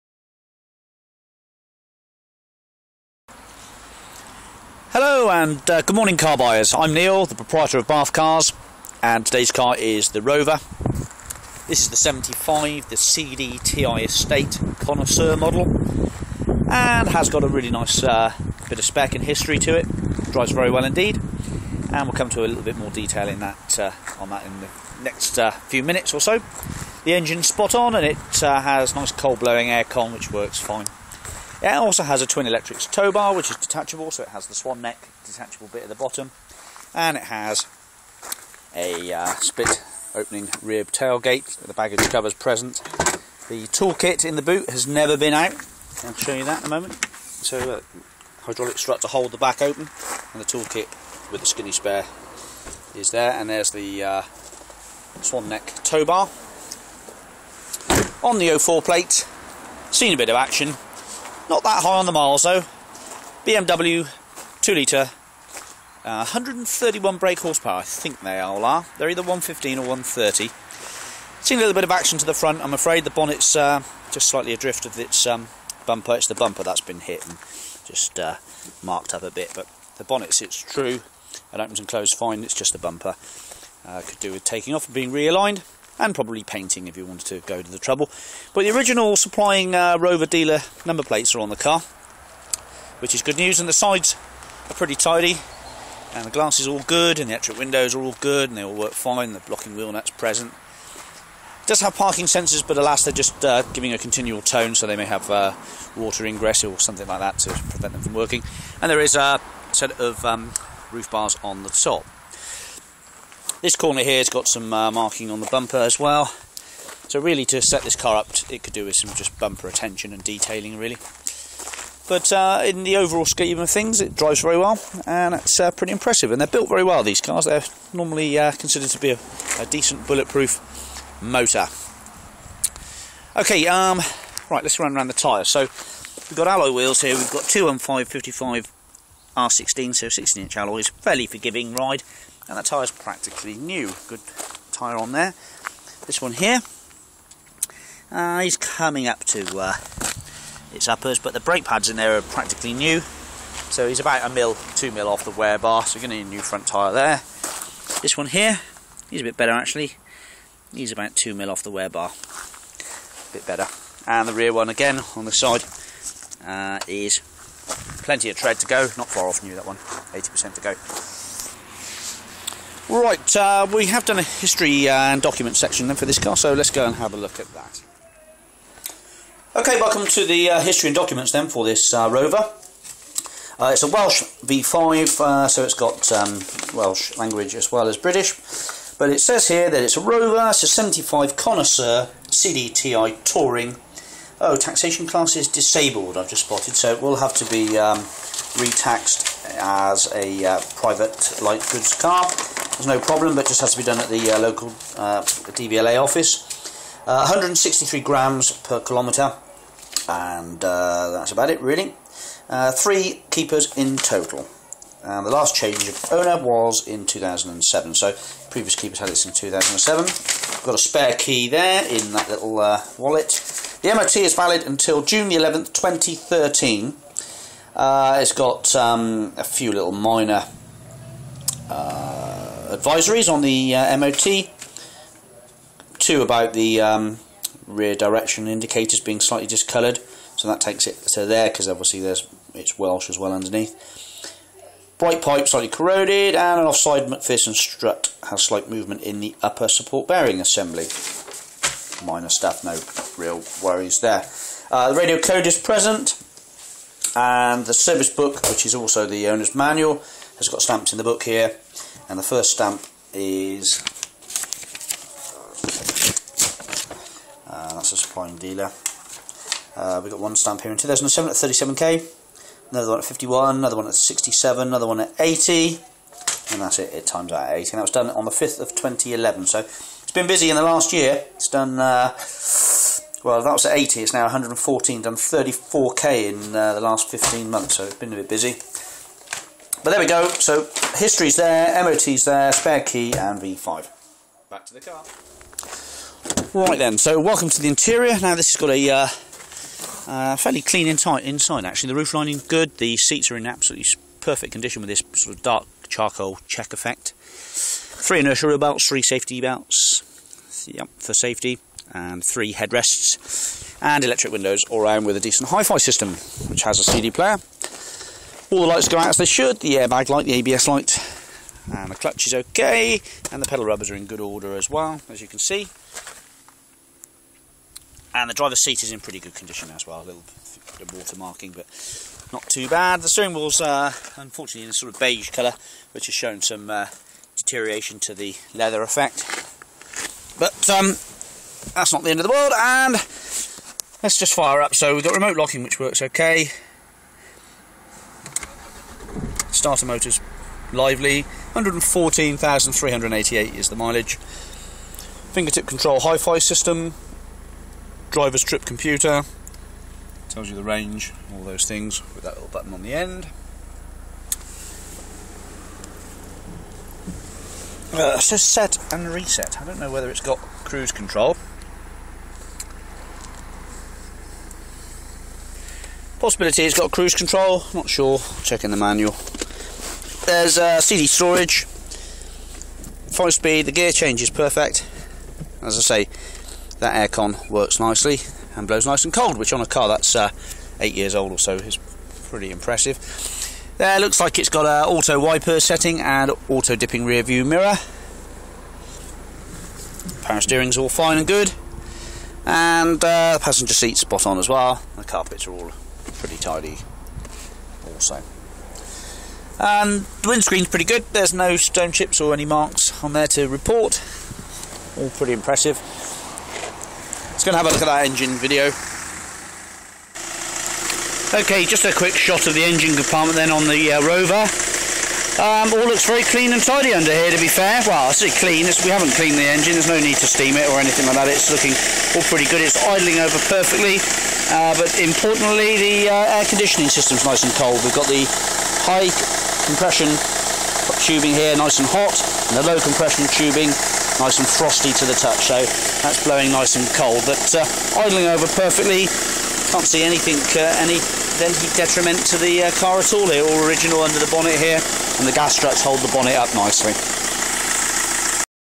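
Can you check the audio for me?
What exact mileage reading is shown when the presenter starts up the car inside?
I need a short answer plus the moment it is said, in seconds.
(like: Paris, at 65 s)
114,388, at 351 s.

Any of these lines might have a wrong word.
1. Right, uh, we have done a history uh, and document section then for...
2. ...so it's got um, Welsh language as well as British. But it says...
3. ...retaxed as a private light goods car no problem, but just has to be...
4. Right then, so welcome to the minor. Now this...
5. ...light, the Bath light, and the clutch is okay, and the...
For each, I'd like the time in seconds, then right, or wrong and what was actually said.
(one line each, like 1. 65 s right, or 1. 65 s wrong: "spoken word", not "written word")
1. 172 s right
2. 185 s right
3. 198 s right
4. 296 s wrong: "interior", not "minor"
5. 320 s wrong: "ABS", not "Bath".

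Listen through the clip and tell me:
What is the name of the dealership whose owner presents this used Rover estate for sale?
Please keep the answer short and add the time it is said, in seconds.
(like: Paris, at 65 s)
Bath Cars, at 7 s.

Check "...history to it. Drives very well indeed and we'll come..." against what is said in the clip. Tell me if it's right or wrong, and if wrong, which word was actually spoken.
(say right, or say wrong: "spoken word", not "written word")
right.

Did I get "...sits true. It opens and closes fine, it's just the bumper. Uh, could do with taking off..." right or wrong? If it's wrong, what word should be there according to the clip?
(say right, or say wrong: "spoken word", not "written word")
right.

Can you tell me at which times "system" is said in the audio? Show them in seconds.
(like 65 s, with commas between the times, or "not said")
315 s, 356 s, 436 s.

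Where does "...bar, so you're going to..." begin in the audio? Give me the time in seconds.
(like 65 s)
155 s.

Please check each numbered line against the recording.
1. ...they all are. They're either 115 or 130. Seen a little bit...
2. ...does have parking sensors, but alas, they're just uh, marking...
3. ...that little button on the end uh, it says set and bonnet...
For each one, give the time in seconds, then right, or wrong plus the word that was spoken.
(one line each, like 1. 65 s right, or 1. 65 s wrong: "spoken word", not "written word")
1. 68 s right
2. 101 s wrong: "giving", not "marking"
3. 362 s wrong: "reset", not "bonnet".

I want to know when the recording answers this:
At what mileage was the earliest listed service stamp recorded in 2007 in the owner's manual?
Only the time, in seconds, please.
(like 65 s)
271 s.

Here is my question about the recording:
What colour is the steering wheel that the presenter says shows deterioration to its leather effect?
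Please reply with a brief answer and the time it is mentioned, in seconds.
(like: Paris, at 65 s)
beige, at 334 s.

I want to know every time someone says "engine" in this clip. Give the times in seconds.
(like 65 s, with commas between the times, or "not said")
27 s, 418 s, 422 s, 429 s.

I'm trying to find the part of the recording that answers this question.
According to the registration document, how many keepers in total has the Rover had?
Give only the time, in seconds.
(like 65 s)
212 s.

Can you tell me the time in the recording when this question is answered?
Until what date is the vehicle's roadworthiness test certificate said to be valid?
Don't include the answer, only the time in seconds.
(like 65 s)
225 s.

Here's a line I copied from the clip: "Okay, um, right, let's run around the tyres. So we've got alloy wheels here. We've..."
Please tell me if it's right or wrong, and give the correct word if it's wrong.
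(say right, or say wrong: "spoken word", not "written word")
right.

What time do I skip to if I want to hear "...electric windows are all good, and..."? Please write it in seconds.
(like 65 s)
97 s.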